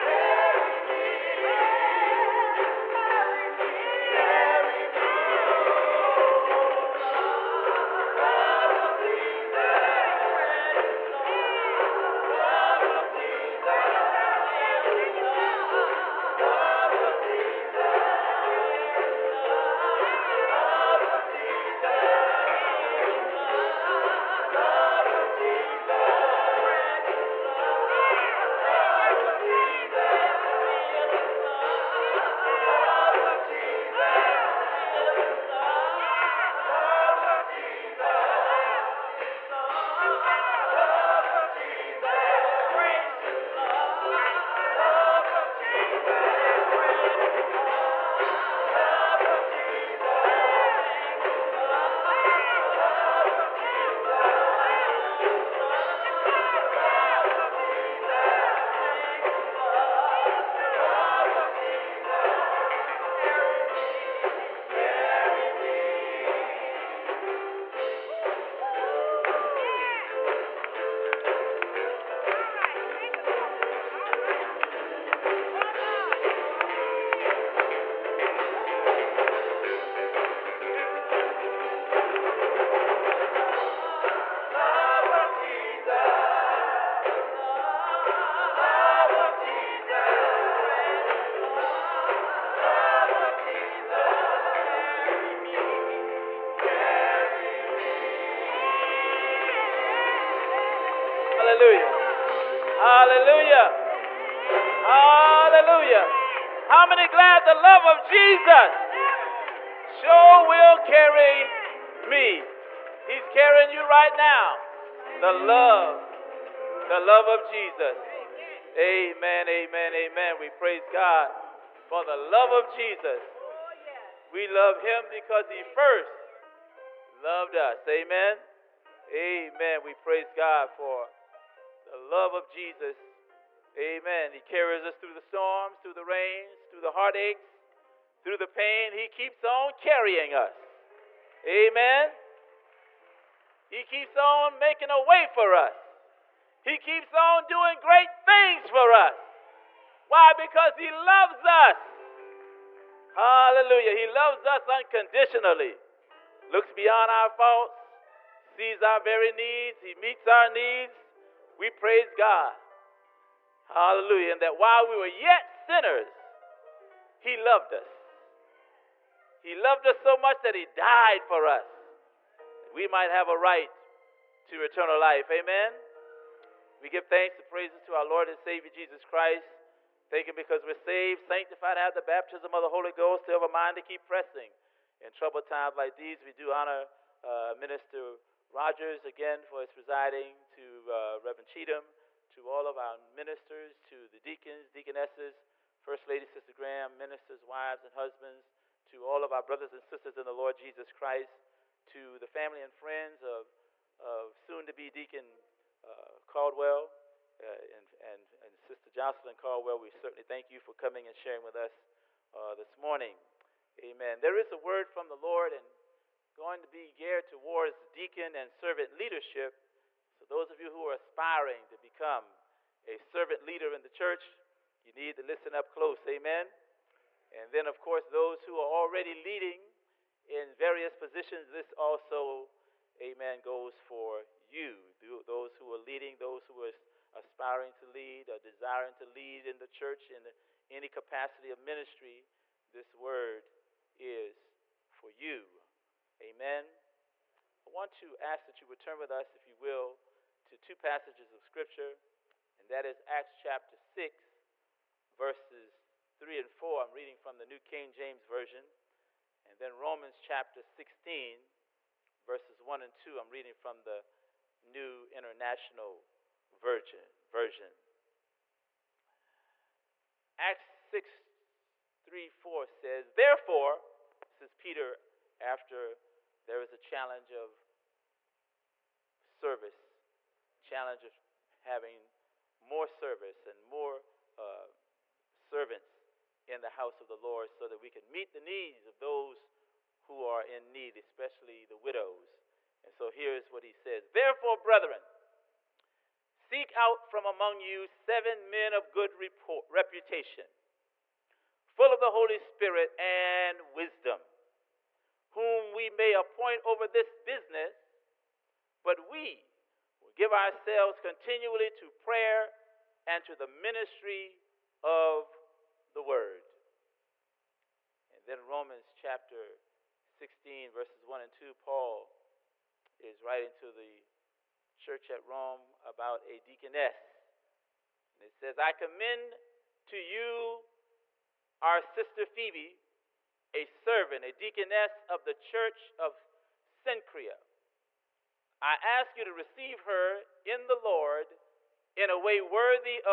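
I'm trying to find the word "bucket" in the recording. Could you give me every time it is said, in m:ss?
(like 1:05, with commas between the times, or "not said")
not said.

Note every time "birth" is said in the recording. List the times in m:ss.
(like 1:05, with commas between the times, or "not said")
not said.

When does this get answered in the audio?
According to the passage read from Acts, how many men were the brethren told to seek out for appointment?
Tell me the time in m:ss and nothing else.
4:57.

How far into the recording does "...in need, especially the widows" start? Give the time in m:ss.
4:50.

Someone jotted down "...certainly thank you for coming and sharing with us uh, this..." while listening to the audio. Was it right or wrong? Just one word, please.
right.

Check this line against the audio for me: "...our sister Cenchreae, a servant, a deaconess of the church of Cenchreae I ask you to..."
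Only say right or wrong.
wrong.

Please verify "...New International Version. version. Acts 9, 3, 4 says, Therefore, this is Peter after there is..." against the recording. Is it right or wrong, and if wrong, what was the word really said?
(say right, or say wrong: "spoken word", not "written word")
wrong: "6", not "9".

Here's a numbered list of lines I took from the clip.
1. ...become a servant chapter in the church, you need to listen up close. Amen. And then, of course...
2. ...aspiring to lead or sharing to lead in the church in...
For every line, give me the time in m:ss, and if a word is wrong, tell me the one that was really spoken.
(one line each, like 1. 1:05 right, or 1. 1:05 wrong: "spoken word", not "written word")
1. 3:41 wrong: "leader", not "chapter"
2. 3:57 wrong: "desiring", not "sharing".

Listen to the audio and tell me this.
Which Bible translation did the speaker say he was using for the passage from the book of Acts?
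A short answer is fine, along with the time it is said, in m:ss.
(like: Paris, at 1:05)
New King James Version, at 4:17.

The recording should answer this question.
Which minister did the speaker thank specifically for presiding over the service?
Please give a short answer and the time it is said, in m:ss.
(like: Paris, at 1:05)
Minister Rogers, at 3:07.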